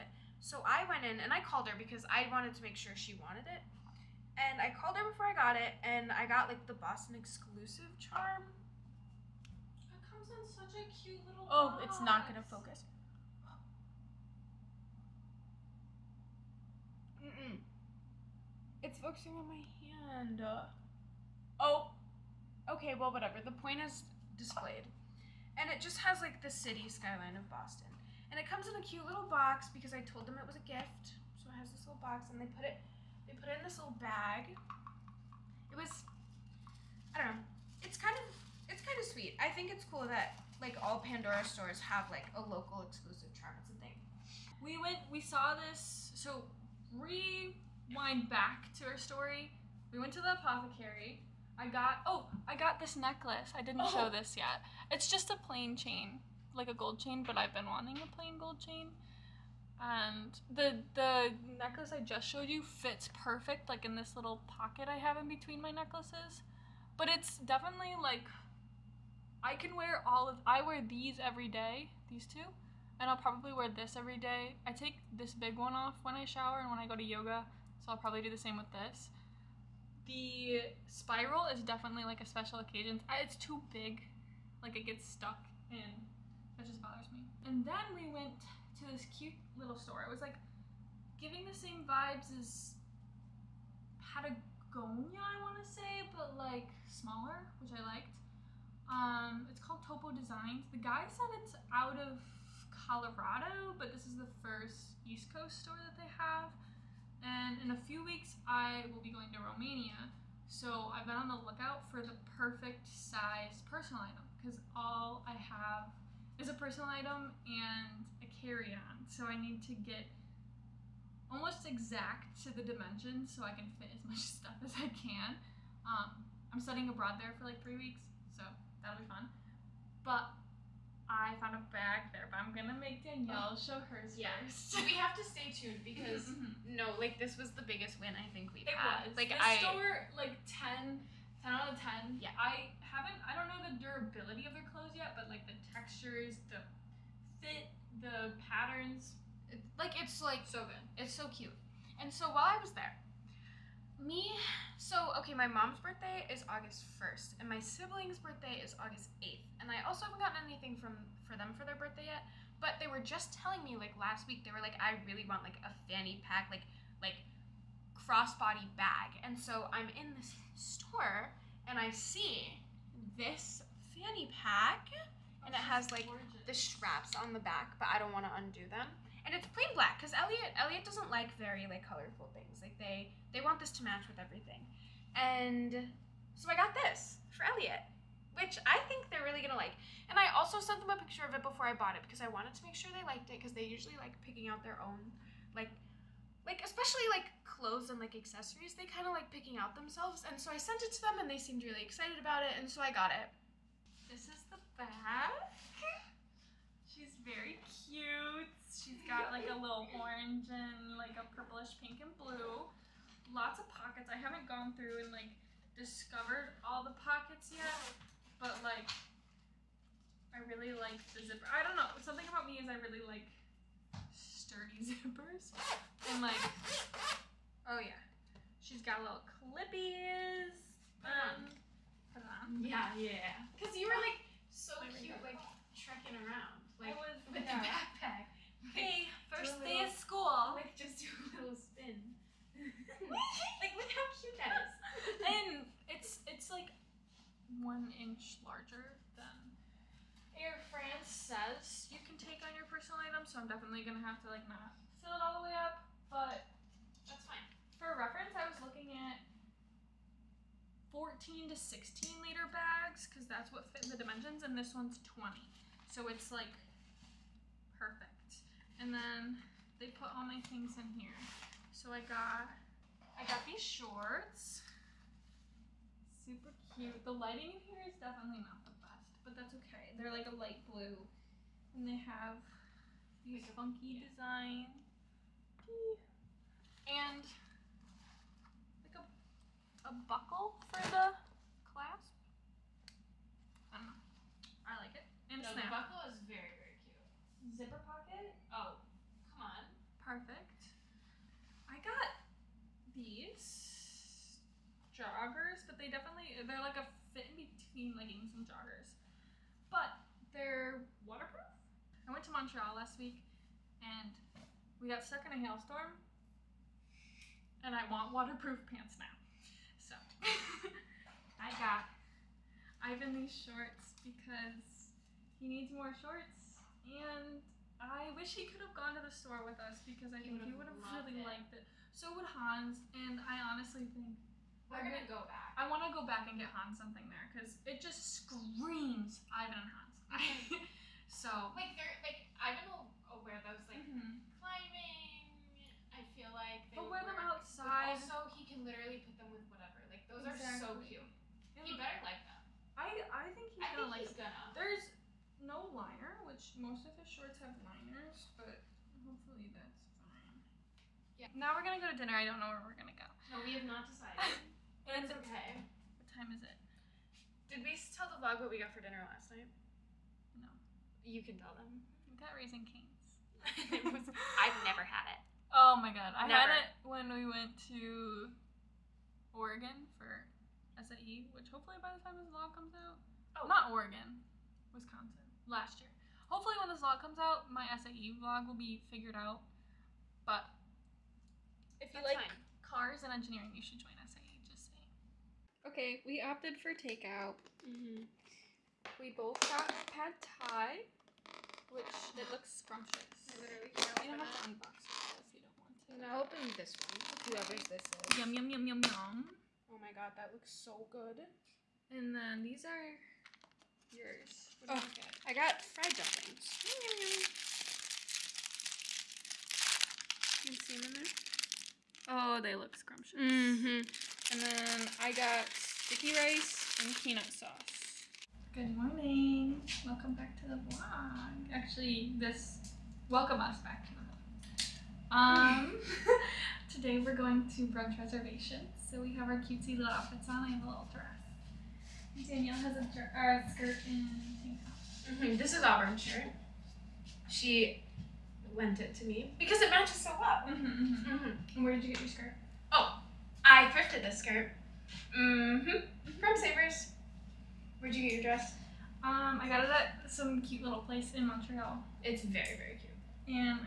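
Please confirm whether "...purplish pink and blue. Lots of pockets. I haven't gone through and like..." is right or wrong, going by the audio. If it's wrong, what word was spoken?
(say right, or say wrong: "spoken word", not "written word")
right.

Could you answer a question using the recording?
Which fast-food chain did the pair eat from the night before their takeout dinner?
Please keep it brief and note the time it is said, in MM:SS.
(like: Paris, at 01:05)
Raising Cane's, at 06:12.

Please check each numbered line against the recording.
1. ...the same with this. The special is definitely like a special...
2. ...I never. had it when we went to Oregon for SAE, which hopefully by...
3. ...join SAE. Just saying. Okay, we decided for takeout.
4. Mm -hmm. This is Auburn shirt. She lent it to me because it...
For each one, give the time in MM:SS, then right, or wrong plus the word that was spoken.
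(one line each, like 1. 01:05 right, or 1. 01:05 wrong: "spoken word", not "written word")
1. 01:18 wrong: "spiral", not "special"
2. 06:16 right
3. 06:33 wrong: "opted", not "decided"
4. 07:25 right.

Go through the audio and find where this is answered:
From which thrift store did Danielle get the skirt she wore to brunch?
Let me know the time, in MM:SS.
07:36.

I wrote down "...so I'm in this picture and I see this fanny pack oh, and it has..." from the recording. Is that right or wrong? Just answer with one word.
wrong.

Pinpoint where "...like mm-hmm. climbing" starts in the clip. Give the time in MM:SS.
05:43.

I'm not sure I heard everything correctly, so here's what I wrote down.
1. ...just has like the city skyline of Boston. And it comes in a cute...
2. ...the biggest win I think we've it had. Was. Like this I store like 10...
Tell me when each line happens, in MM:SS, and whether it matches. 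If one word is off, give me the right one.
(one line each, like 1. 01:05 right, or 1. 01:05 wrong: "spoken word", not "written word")
1. 00:25 right
2. 02:17 right.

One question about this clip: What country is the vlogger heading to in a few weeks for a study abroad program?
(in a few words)
Romania.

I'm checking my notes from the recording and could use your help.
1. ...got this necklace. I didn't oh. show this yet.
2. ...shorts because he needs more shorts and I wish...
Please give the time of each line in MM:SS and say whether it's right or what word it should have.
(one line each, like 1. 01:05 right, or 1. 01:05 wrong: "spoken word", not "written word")
1. 00:52 right
2. 05:23 right.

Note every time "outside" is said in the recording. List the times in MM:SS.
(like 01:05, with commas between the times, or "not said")
05:47.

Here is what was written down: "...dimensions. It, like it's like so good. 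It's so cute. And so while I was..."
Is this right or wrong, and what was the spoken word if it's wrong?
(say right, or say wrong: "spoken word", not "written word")
wrong: "patterns", not "dimensions".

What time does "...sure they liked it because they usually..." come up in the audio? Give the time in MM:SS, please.
03:12.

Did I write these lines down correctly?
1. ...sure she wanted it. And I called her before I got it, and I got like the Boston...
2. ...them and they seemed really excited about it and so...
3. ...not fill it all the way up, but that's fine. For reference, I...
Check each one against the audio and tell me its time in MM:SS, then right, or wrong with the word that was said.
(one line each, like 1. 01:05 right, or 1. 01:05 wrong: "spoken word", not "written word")
1. 00:02 right
2. 03:21 right
3. 04:14 right.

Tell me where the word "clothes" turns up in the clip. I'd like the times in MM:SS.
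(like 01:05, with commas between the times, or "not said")
02:24, 03:17.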